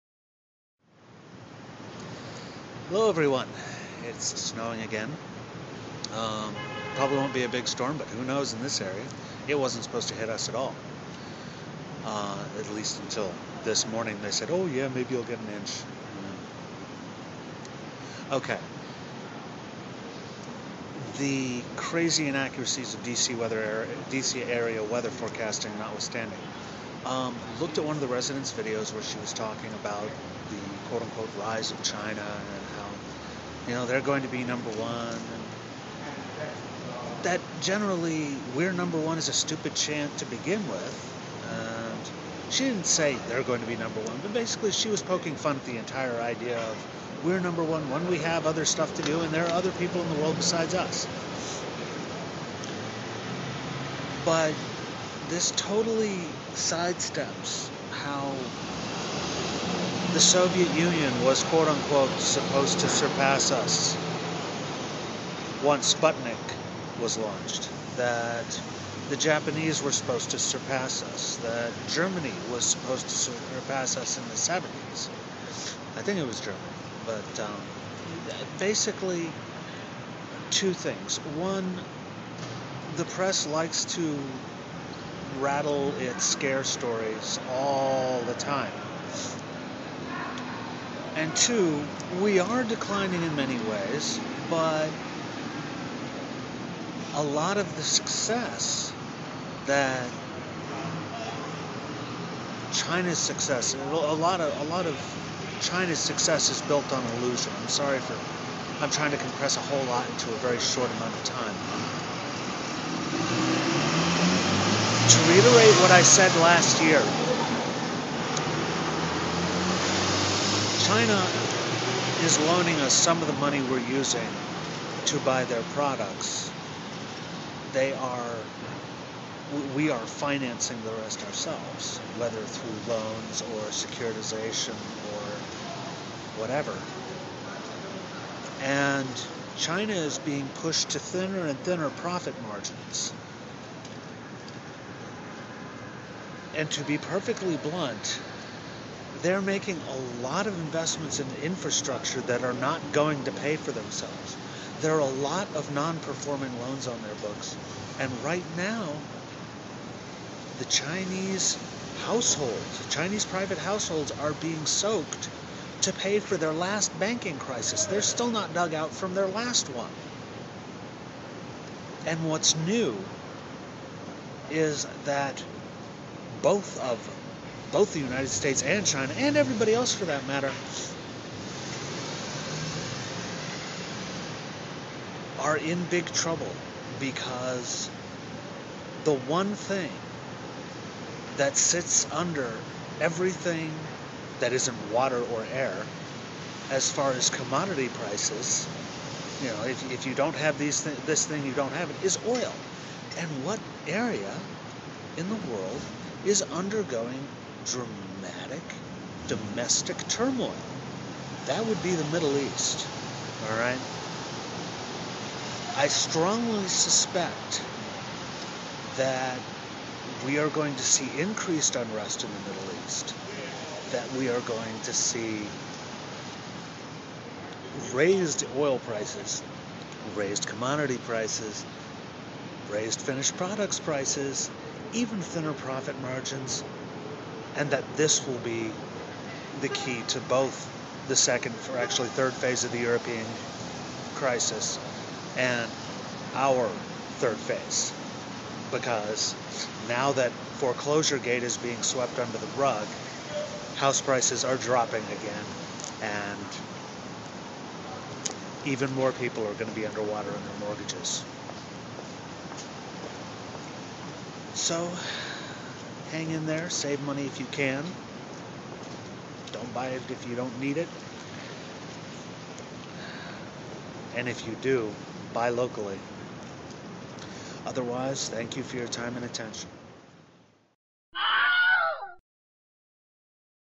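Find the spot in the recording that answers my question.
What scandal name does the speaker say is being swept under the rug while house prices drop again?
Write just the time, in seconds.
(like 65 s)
250 s.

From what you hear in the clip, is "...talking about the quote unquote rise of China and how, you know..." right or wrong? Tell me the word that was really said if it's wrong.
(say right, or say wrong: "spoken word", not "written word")
right.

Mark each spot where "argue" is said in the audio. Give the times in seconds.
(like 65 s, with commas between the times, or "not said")
not said.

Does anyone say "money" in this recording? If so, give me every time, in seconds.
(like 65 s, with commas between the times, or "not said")
123 s, 267 s.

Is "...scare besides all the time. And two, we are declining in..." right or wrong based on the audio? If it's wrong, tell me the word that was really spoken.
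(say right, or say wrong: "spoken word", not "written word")
wrong: "stories", not "besides".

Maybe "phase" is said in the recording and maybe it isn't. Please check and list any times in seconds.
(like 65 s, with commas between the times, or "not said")
242 s, 247 s.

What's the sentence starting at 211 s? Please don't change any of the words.
That would be the Middle East, all right?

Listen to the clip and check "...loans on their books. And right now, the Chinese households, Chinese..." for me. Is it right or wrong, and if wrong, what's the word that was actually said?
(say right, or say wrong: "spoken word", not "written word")
right.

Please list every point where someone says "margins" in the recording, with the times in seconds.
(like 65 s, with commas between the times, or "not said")
142 s, 236 s.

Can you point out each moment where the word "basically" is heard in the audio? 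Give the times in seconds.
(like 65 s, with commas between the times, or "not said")
44 s, 78 s.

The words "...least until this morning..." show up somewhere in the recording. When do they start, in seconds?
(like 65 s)
12 s.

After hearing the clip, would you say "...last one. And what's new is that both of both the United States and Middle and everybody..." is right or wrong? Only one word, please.
wrong.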